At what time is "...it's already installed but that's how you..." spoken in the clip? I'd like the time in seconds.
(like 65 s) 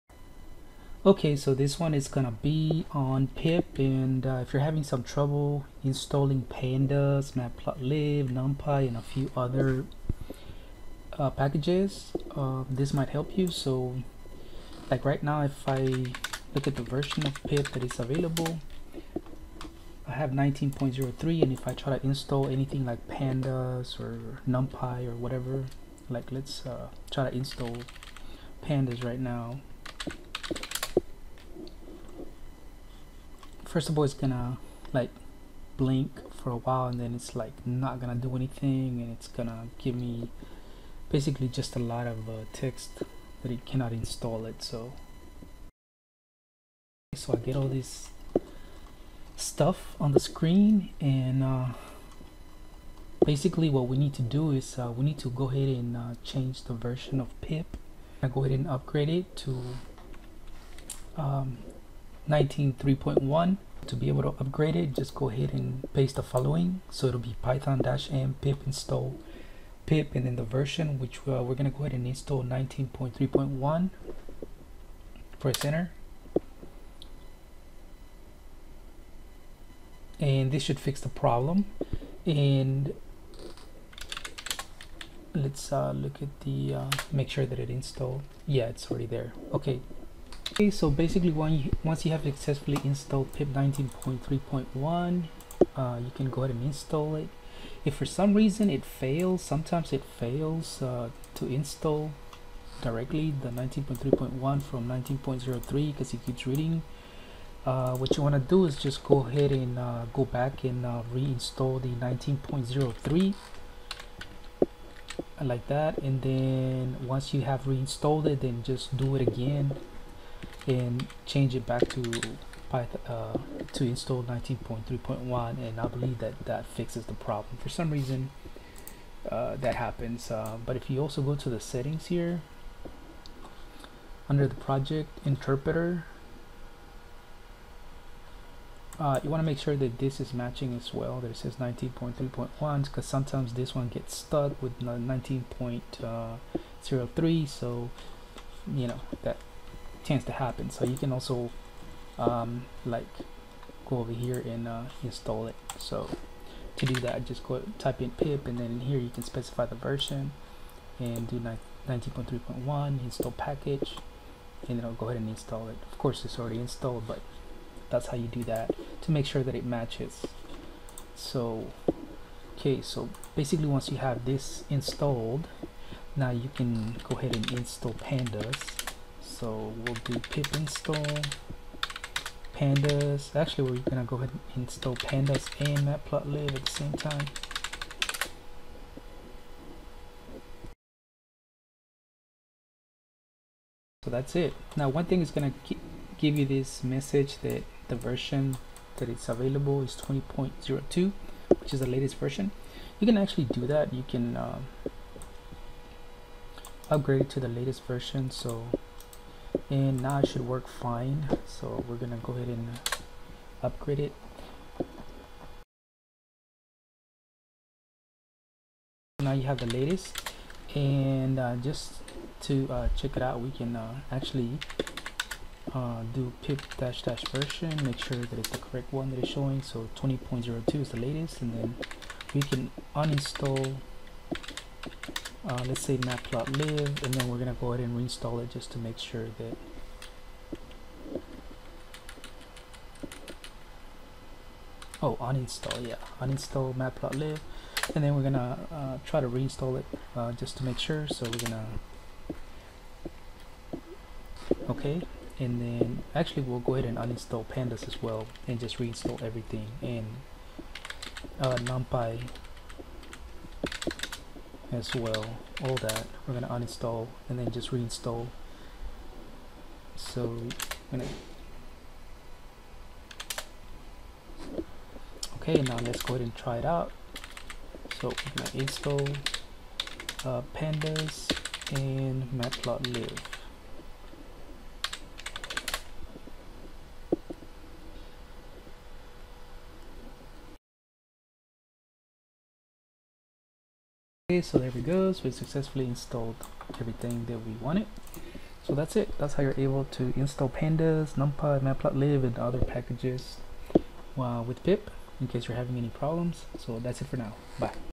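166 s.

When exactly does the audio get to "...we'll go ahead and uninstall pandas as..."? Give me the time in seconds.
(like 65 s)
256 s.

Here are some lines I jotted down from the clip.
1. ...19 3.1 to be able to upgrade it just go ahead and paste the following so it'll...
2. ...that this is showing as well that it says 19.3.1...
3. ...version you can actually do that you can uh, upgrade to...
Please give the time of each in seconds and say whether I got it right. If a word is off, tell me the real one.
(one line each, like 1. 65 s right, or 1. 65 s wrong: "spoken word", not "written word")
1. 62 s right
2. 139 s wrong: "matching", not "showing"
3. 202 s right.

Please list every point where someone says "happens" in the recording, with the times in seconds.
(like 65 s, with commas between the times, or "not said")
129 s, 150 s.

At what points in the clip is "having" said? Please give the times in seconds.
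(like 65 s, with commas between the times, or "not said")
4 s, 305 s.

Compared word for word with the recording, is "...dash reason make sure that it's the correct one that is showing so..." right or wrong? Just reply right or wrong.
wrong.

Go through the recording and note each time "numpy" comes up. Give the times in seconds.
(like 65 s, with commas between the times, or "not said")
8 s, 24 s, 261 s, 301 s.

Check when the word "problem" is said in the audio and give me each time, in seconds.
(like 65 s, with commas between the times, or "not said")
81 s, 127 s, 305 s.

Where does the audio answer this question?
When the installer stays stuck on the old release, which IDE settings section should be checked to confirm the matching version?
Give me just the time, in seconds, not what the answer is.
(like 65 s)
134 s.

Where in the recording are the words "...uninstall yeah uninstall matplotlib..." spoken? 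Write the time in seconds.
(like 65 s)
245 s.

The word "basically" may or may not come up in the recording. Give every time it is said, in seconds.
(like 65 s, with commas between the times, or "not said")
41 s, 53 s, 90 s, 173 s.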